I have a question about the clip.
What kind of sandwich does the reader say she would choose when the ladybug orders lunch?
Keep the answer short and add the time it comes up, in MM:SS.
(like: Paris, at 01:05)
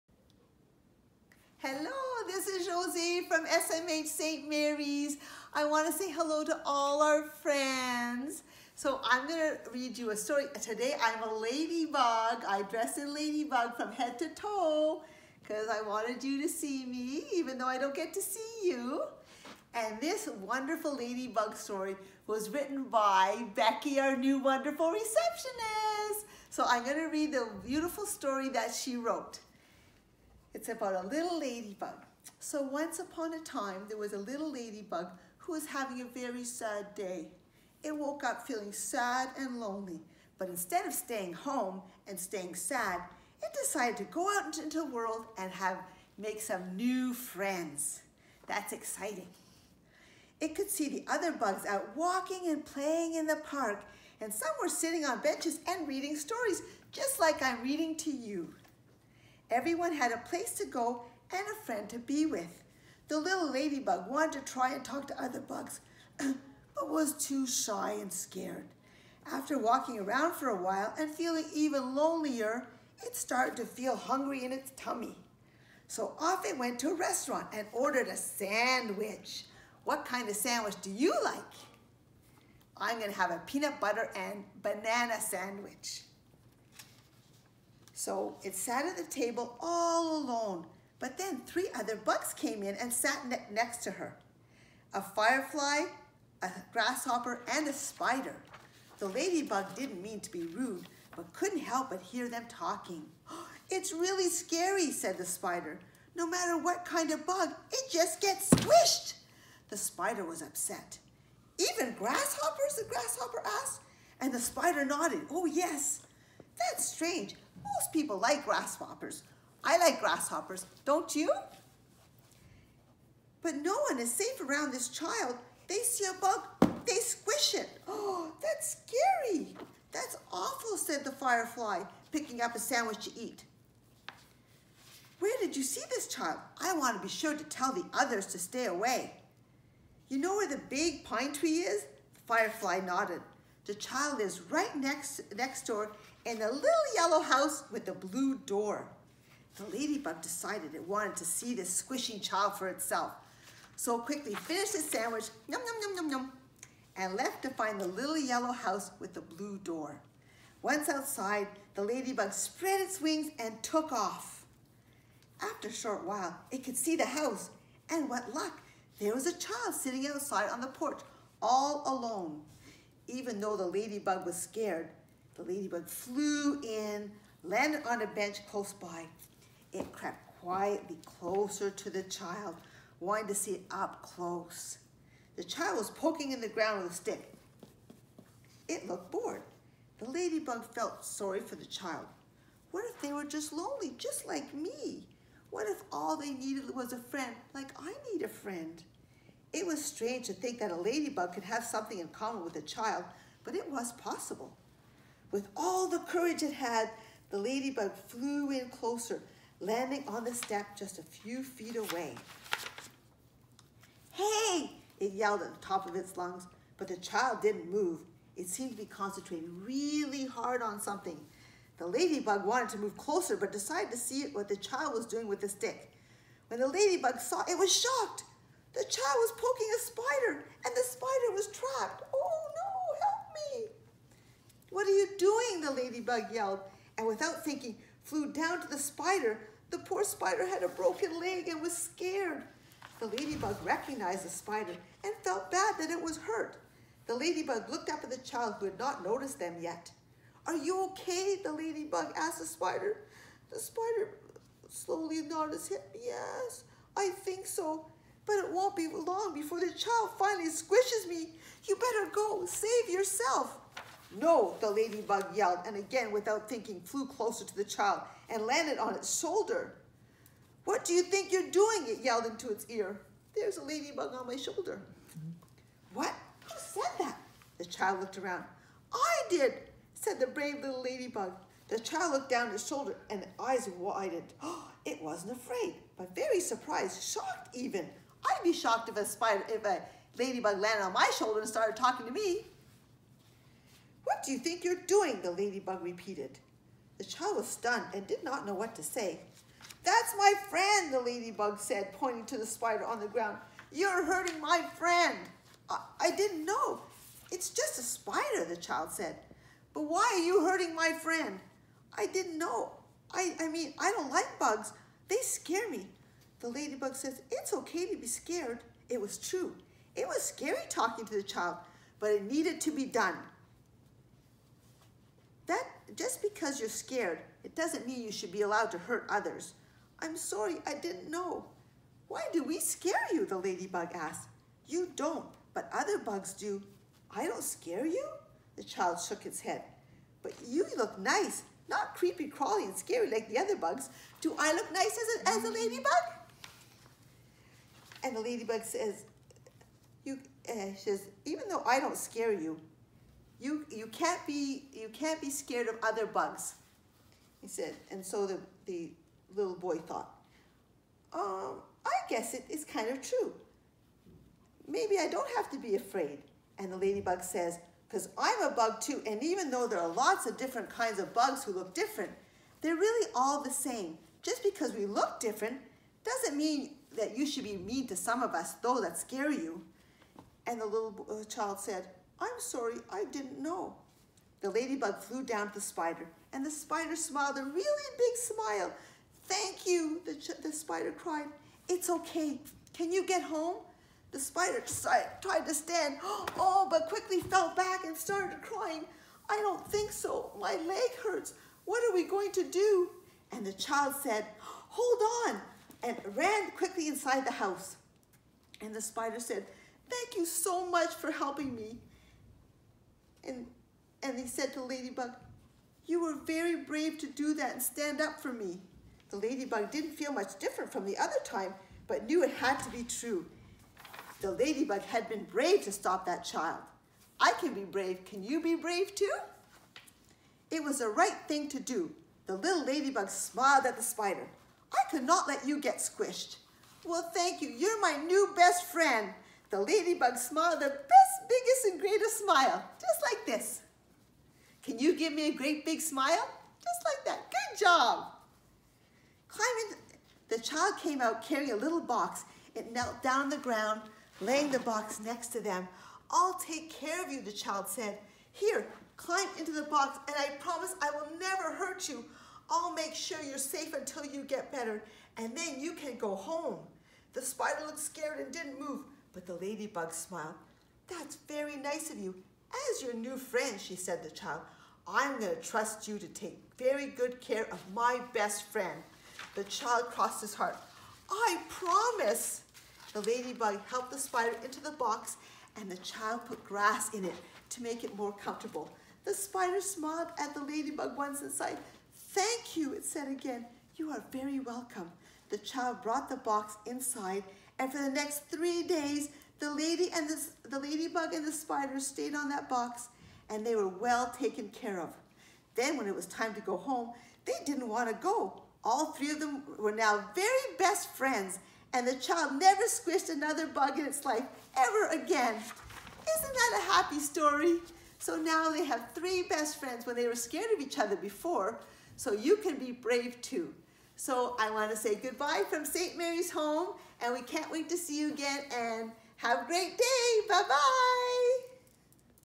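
Peanut butter and banana, at 01:23.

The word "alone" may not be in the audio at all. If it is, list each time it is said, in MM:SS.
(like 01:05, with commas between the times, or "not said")
01:30, 02:51.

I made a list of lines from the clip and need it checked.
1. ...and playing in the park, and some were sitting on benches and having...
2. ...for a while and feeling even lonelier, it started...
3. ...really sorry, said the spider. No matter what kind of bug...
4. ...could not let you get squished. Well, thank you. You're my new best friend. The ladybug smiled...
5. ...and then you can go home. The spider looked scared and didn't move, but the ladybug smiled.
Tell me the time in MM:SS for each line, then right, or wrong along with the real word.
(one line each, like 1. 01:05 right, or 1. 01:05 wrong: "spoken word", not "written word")
1. 00:52 wrong: "reading", not "having"
2. 01:10 right
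3. 01:43 wrong: "scary", not "sorry"
4. 07:14 right
5. 07:45 right.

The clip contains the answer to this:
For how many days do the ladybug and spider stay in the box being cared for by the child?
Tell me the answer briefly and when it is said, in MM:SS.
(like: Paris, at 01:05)
3, at 08:18.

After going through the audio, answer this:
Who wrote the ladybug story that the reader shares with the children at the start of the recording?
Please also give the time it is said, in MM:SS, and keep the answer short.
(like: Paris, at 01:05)
Becky, at 00:23.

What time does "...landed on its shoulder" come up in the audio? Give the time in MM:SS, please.
04:28.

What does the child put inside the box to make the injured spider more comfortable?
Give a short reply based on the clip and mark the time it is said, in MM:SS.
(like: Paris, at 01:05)
Grass, at 08:06.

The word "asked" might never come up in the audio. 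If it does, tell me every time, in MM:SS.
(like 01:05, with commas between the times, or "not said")
01:53, 04:12, 05:33.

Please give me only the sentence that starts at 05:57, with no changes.
And so the, the little boy thought, um, I guess it is kind of true.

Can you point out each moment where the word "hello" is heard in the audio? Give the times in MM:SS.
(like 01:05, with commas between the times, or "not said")
00:01, 00:06.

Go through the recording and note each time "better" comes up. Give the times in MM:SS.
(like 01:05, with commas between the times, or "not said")
04:21, 07:44.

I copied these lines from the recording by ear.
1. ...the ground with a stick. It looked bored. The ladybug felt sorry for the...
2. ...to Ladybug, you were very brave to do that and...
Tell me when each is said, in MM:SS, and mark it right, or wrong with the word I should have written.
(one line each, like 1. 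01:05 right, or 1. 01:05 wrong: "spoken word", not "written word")
1. 03:06 right
2. 06:54 right.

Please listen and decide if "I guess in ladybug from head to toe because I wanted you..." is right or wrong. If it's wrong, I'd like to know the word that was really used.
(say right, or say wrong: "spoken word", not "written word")
wrong: "dress", not "guess".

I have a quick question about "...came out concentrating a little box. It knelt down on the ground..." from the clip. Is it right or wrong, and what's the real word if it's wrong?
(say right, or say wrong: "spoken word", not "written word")
wrong: "carrying", not "concentrating".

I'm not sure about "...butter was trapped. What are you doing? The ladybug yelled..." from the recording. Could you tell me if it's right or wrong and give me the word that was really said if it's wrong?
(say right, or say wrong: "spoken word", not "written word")
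wrong: "spider", not "butter".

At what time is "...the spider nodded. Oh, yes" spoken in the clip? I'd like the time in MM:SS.
01:54.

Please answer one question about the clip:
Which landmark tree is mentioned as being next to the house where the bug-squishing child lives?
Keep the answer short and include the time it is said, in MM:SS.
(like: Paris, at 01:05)
The big pine tree, at 02:20.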